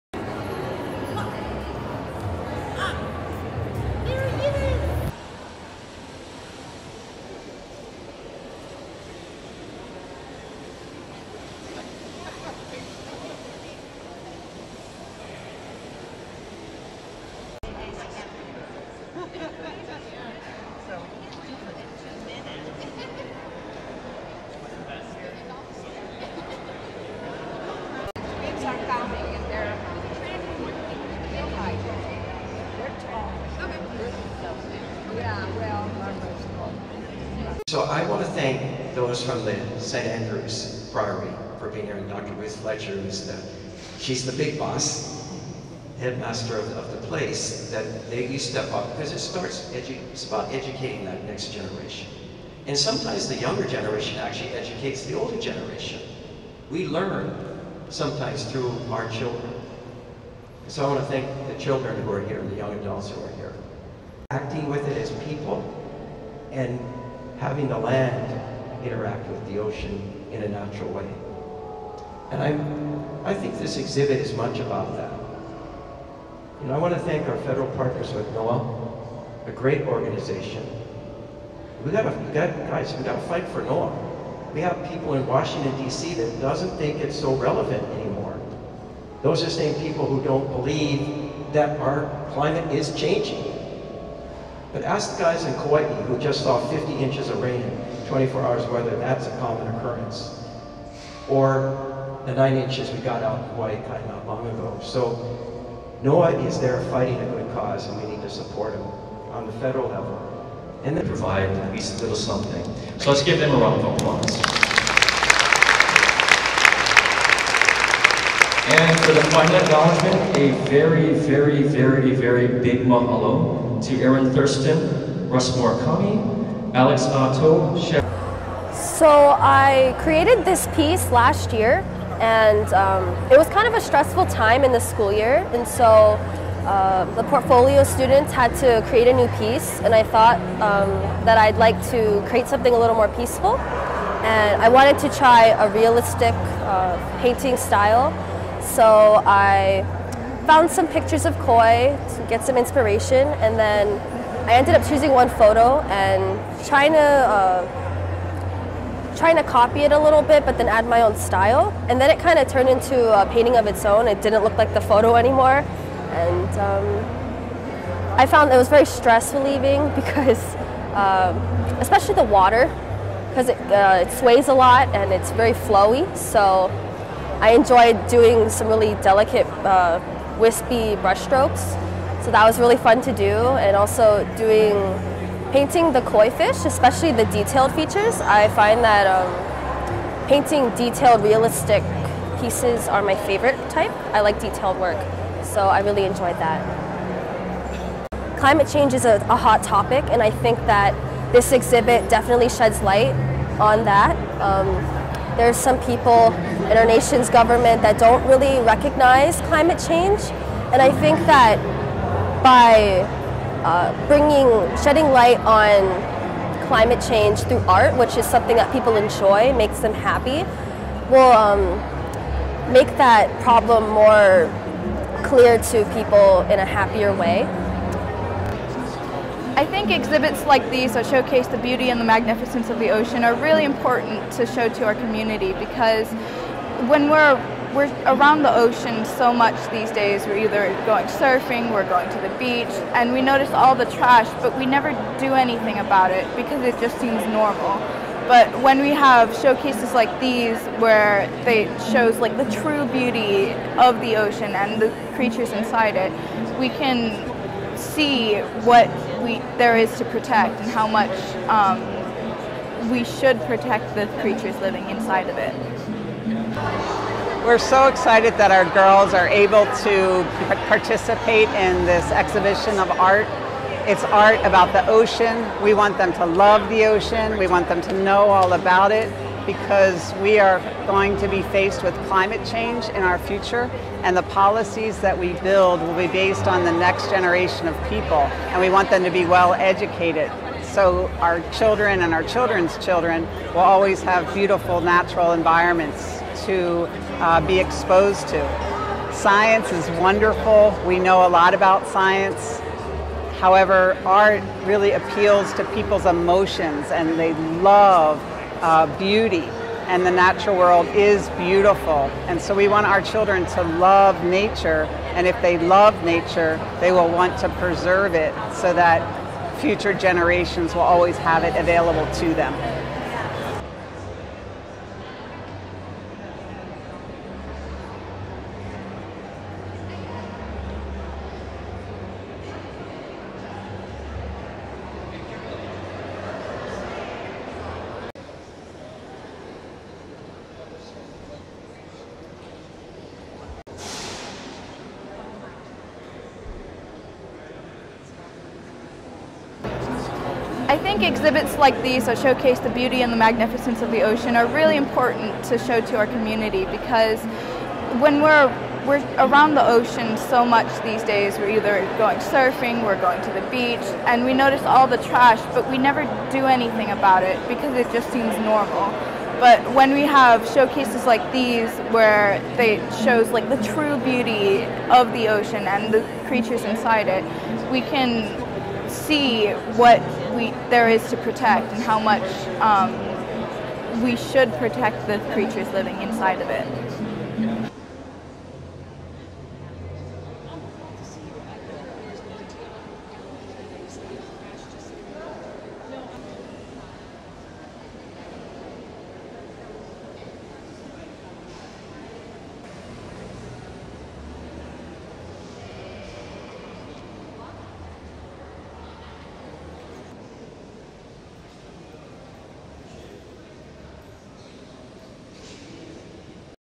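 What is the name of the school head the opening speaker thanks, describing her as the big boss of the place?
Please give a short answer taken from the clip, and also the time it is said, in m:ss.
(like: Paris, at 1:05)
Dr. Ruth Fletcher, at 0:42.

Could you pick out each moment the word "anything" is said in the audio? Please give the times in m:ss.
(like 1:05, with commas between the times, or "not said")
4:05, 6:06.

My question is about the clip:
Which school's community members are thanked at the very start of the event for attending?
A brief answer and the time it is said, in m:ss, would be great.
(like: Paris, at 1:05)
St. Andrews Priory, at 0:39.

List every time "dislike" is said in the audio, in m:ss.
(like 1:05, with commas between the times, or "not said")
not said.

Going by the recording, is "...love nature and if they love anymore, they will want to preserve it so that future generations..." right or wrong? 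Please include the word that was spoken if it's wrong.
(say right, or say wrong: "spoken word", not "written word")
wrong: "nature", not "anymore".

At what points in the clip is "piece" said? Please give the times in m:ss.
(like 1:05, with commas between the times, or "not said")
2:10, 2:19, 3:12.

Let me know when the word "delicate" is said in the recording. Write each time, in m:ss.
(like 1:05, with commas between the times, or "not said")
2:59.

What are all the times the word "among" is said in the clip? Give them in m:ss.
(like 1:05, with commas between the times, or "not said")
not said.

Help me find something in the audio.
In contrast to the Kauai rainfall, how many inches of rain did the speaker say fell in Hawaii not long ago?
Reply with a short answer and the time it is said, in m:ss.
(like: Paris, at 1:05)
9 inches, at 1:42.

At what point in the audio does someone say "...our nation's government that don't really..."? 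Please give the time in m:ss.
3:26.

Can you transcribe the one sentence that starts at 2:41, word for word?
And then it kind of turned into a painting of its own.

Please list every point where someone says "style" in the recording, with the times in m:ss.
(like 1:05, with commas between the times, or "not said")
2:27, 2:41.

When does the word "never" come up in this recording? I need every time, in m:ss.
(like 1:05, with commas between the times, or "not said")
4:04, 6:05.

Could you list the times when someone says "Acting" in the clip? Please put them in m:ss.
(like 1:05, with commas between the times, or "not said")
1:04.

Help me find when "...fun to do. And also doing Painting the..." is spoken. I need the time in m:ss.
3:02.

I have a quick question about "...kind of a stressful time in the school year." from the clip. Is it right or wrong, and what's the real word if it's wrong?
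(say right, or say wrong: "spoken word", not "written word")
right.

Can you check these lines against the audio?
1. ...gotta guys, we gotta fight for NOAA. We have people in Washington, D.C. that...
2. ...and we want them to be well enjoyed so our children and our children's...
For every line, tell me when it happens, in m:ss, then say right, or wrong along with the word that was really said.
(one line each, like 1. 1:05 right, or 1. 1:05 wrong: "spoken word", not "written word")
1. 1:22 right
2. 4:48 wrong: "educated", not "enjoyed".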